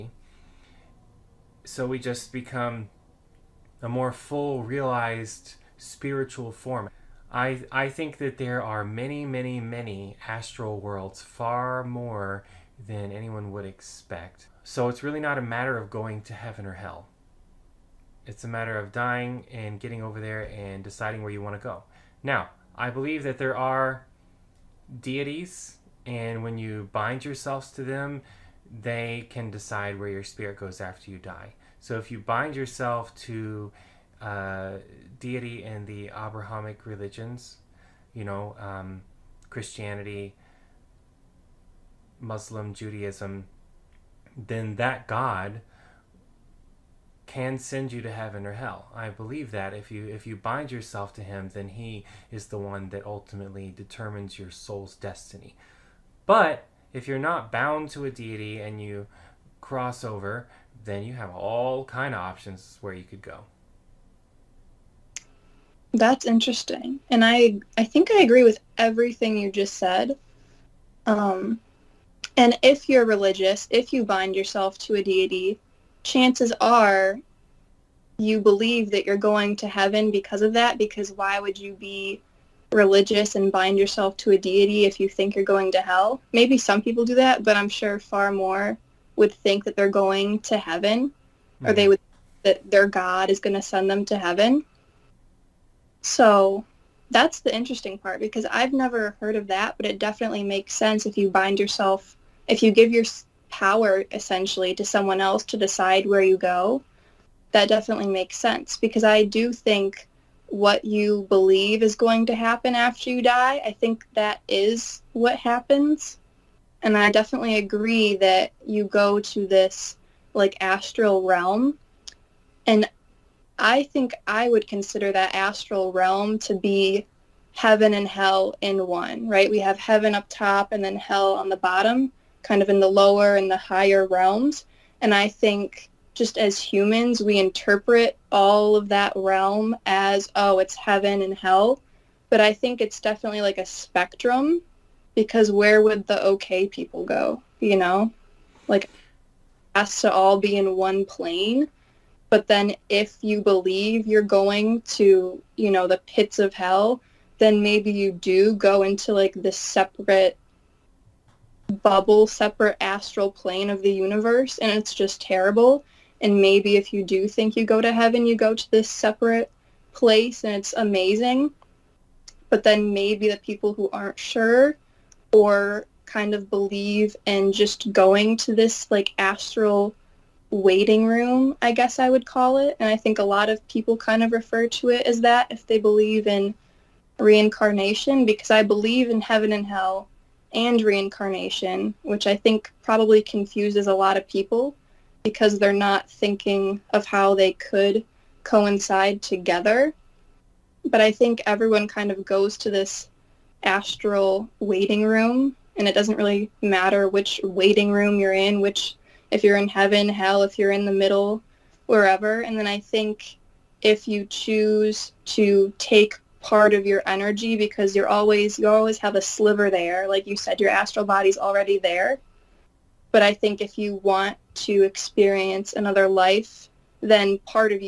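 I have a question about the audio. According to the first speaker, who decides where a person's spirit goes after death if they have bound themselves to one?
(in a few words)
deities.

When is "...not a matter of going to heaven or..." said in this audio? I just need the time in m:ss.
0:15.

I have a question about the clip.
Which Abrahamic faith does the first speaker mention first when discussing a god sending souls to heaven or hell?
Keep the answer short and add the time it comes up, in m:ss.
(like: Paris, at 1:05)
Christianity, at 0:39.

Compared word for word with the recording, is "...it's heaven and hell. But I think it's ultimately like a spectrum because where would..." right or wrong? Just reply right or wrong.
wrong.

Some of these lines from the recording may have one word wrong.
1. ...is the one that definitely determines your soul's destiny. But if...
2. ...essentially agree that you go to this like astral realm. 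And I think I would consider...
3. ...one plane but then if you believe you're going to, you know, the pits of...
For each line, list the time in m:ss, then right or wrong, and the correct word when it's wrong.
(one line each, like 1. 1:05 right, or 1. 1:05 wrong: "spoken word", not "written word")
1. 0:52 wrong: "ultimately", not "definitely"
2. 1:57 wrong: "definitely", not "essentially"
3. 2:30 right.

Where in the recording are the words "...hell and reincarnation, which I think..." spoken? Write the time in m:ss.
3:09.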